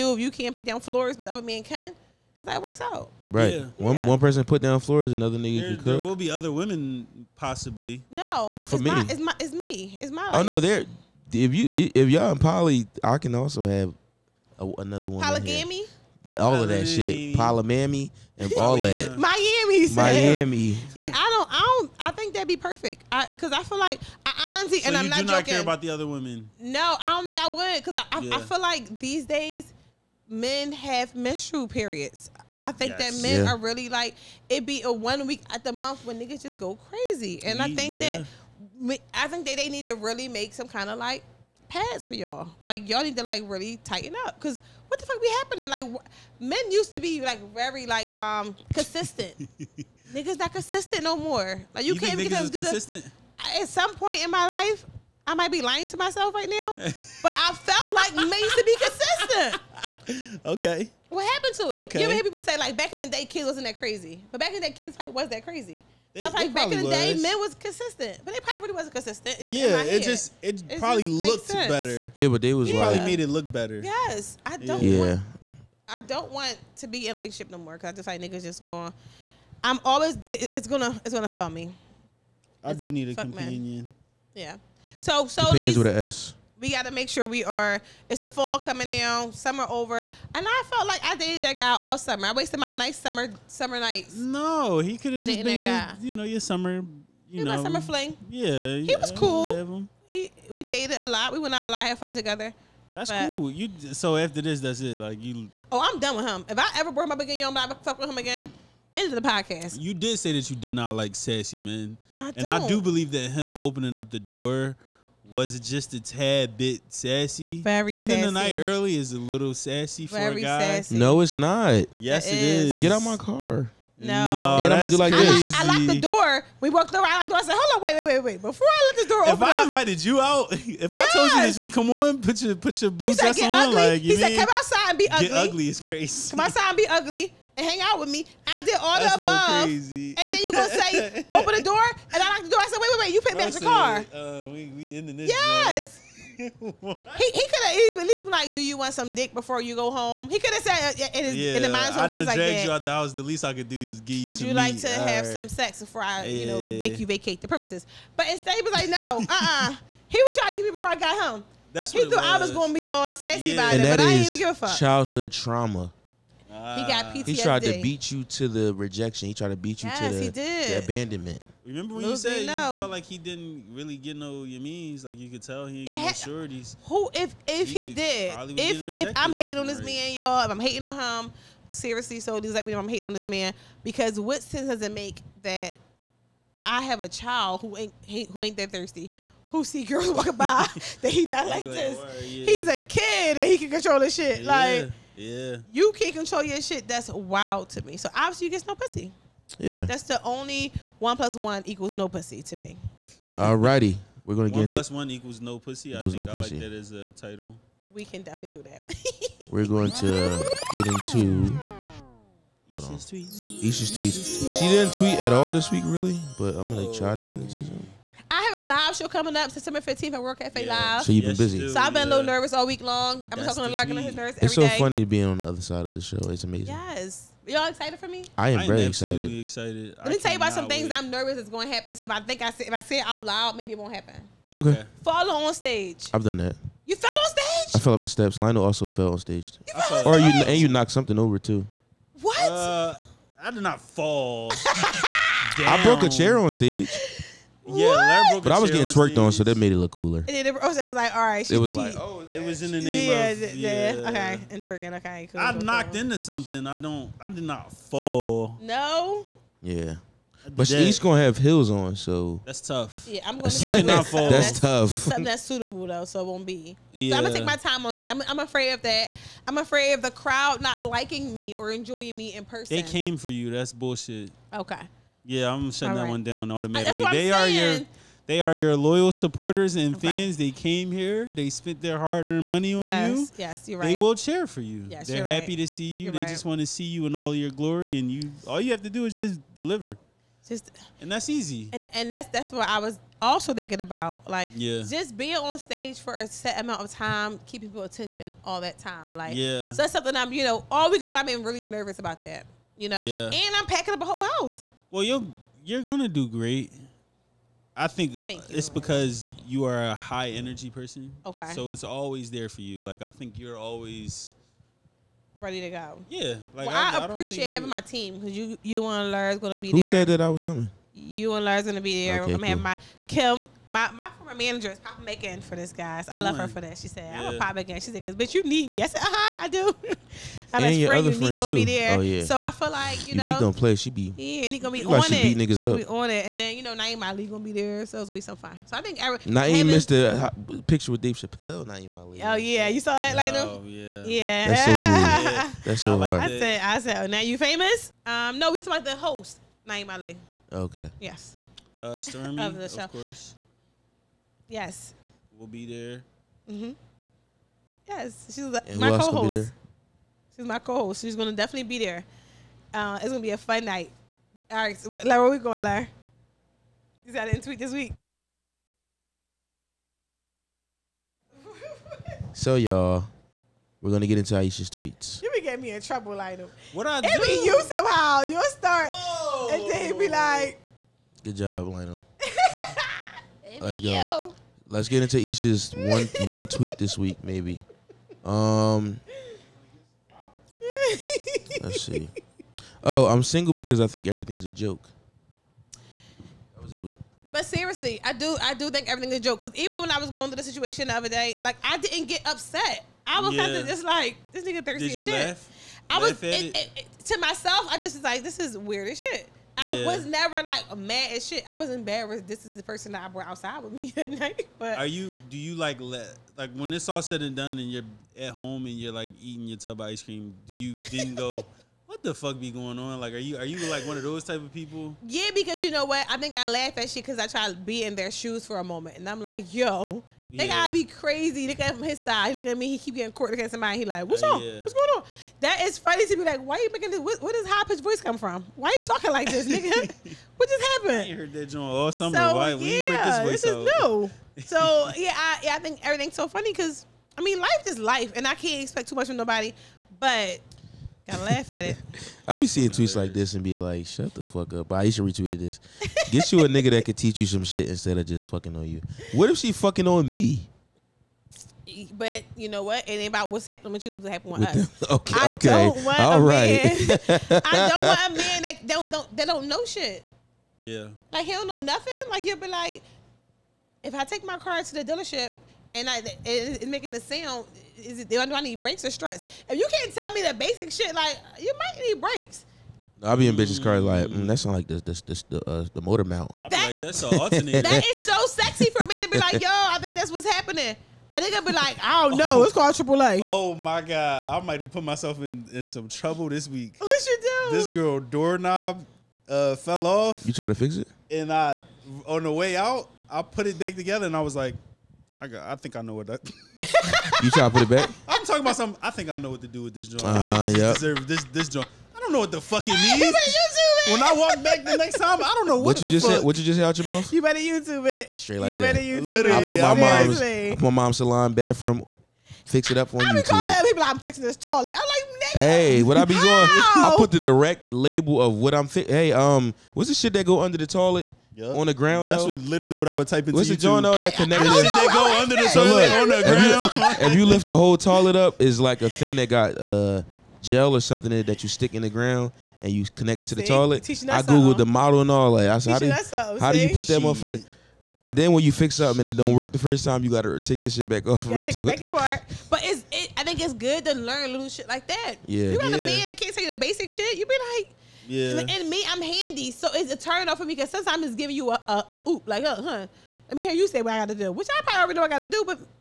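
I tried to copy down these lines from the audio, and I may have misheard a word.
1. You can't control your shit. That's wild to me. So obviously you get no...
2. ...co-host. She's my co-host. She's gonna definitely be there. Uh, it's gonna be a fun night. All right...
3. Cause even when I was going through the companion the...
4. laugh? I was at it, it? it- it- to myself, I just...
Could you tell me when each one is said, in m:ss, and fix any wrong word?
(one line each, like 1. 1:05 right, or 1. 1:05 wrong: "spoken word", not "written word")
1. 3:15 right
2. 5:58 right
3. 6:39 wrong: "situation", not "companion"
4. 6:45 right.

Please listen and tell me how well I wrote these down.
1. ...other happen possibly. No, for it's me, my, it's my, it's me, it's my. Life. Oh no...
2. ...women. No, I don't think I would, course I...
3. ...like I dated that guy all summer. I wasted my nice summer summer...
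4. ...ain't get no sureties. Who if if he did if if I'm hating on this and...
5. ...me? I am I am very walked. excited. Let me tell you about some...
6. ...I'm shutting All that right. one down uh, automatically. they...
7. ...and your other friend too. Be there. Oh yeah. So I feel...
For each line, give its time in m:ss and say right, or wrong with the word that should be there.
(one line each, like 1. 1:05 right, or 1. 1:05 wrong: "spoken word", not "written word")
1. 0:06 wrong: "women", not "happen"
2. 0:26 wrong: "cause", not "course"
3. 1:30 right
4. 2:55 right
5. 3:48 wrong: "excited", not "walked"
6. 4:35 right
7. 5:30 right.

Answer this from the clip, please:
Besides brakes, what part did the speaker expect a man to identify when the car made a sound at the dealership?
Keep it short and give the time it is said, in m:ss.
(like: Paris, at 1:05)
Struts, at 7:58.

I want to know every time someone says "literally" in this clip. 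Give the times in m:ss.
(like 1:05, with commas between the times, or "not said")
8:39, 8:52.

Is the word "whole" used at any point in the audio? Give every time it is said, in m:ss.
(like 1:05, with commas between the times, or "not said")
5:04, 8:57.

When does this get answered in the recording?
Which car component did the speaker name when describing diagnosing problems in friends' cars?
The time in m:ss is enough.
8:05.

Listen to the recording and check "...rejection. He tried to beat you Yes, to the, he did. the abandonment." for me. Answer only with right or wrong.
right.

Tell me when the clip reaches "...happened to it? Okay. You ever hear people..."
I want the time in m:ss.
1:01.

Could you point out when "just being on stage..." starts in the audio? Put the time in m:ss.
4:54.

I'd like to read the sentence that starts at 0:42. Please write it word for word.
Like y'all need to like really tighten up because what the fuck be happening?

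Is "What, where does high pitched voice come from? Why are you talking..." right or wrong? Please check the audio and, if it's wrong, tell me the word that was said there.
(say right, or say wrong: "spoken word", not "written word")
right.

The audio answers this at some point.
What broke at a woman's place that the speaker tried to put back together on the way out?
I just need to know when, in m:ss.
8:17.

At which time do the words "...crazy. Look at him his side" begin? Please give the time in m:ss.
7:10.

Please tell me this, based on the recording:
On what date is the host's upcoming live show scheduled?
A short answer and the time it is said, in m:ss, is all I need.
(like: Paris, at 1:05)
September 15th, at 3:39.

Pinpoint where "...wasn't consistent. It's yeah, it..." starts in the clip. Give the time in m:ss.
1:08.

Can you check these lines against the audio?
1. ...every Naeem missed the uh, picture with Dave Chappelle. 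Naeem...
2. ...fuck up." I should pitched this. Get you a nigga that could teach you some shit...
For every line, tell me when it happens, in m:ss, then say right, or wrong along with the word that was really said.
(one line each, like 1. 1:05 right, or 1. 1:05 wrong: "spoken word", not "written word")
1. 5:39 right
2. 7:34 wrong: "retweeted", not "pitched".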